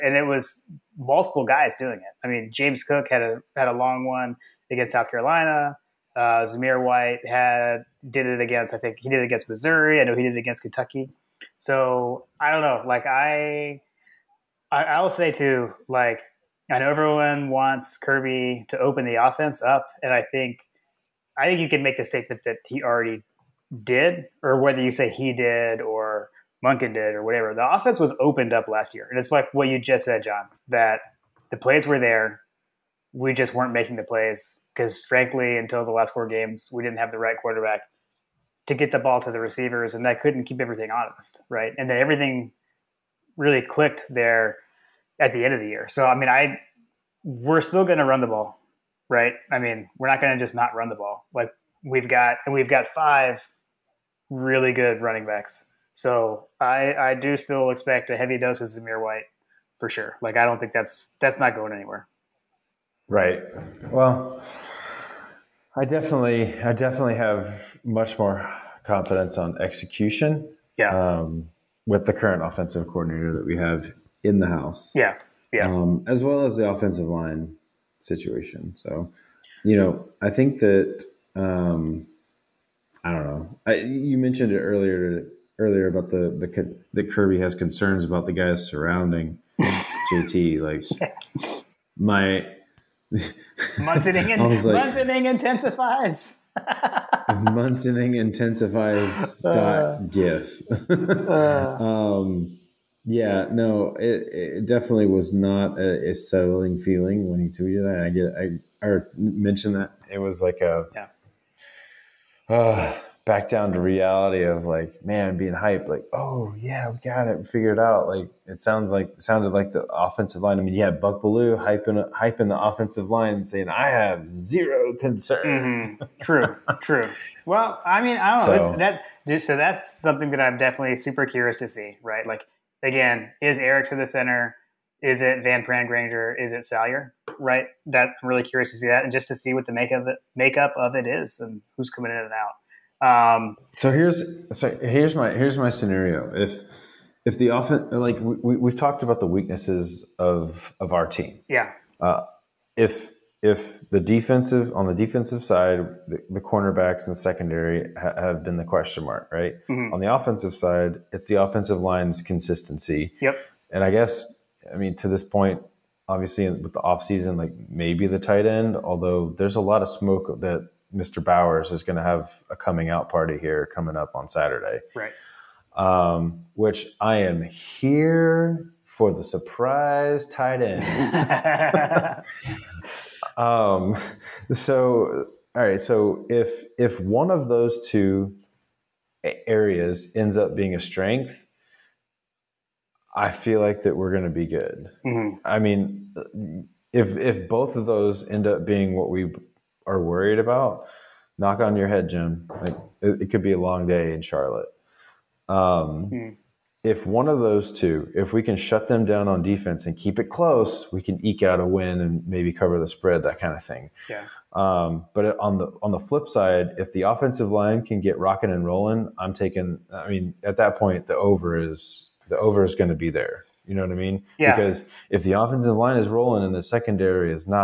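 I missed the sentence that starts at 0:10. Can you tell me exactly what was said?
I know he did it against Kentucky.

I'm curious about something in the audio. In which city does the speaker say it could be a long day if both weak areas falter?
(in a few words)
Charlotte.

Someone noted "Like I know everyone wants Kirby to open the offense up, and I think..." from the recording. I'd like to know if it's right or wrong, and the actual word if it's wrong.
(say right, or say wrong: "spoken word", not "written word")
right.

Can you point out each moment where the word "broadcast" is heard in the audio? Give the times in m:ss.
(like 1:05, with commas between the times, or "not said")
not said.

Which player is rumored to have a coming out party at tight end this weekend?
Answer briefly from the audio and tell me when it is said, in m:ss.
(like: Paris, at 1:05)
Bowers, at 2:51.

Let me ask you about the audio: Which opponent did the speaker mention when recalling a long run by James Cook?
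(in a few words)
South Carolina.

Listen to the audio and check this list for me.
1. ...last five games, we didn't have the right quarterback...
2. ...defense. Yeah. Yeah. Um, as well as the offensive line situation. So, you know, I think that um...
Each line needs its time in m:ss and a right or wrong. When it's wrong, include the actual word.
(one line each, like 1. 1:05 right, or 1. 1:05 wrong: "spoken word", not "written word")
1. 0:35 wrong: "four", not "five"
2. 1:14 wrong: "house", not "defense".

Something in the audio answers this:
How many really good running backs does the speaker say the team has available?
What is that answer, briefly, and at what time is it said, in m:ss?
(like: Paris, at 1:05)
5, at 0:52.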